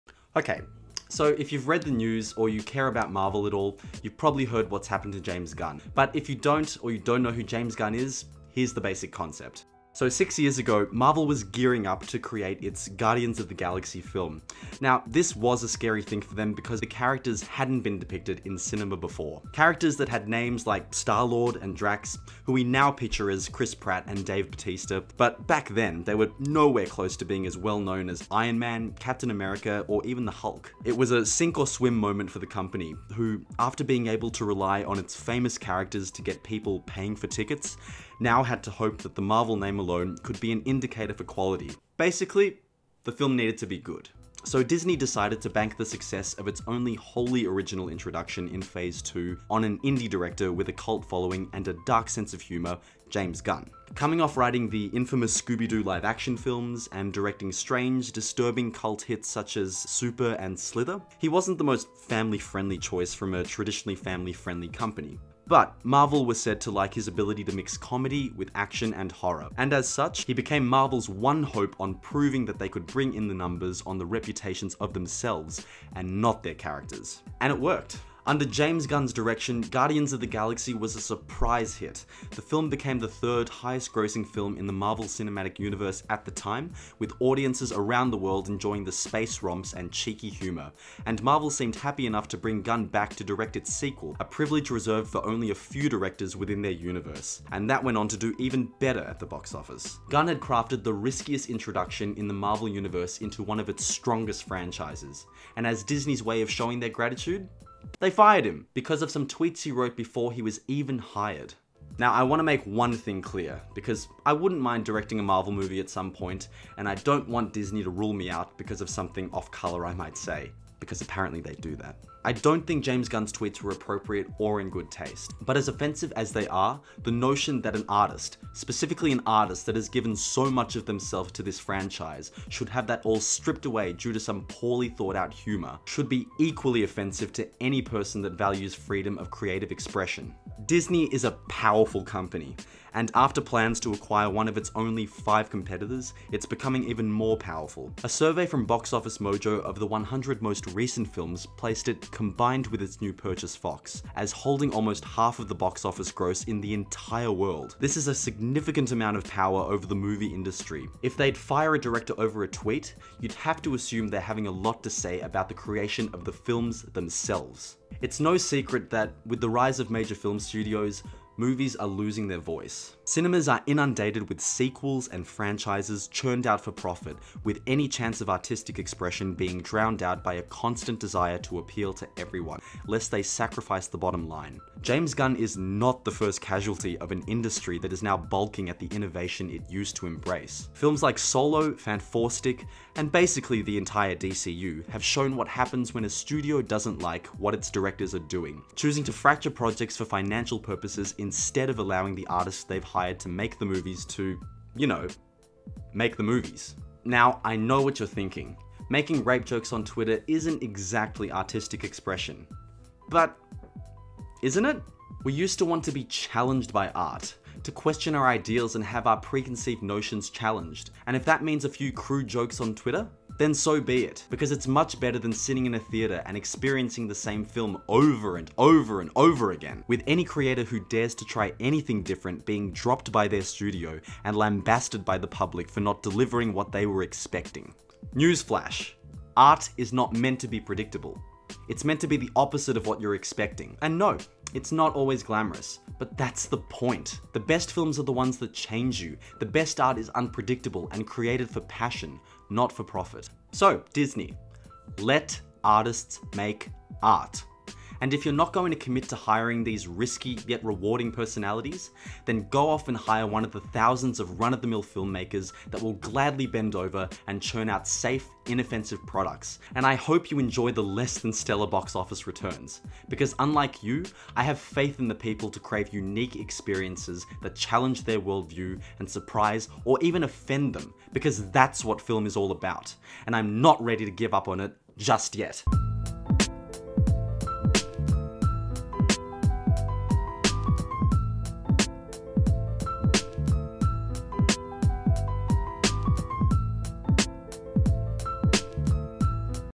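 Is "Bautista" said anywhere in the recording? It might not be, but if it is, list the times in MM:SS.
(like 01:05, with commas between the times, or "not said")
00:24.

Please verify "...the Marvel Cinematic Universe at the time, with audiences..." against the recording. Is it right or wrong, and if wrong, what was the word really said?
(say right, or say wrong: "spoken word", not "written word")
right.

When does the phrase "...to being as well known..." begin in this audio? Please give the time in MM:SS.
00:27.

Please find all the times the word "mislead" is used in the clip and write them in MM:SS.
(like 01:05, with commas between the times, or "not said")
not said.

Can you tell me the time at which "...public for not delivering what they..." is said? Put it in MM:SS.
03:55.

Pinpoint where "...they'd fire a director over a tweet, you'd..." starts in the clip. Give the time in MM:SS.
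02:41.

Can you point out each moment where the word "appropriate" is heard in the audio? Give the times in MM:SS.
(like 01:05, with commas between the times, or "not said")
02:03.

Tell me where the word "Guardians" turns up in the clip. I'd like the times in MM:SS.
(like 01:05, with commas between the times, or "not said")
00:12, 01:19.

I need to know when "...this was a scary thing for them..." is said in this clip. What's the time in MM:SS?
00:15.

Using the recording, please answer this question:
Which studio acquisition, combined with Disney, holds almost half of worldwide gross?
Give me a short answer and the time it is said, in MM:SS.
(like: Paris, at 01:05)
Fox, at 02:33.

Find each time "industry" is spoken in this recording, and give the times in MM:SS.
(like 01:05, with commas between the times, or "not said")
02:40, 03:07.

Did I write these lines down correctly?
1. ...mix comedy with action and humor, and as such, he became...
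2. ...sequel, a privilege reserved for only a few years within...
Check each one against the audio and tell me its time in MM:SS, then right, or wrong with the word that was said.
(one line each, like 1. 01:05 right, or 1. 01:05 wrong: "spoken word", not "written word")
1. 01:07 wrong: "horror", not "humor"
2. 01:33 wrong: "directors", not "years".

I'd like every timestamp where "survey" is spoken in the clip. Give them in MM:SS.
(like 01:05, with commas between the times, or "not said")
02:28.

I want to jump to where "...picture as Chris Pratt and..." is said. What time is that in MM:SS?
00:22.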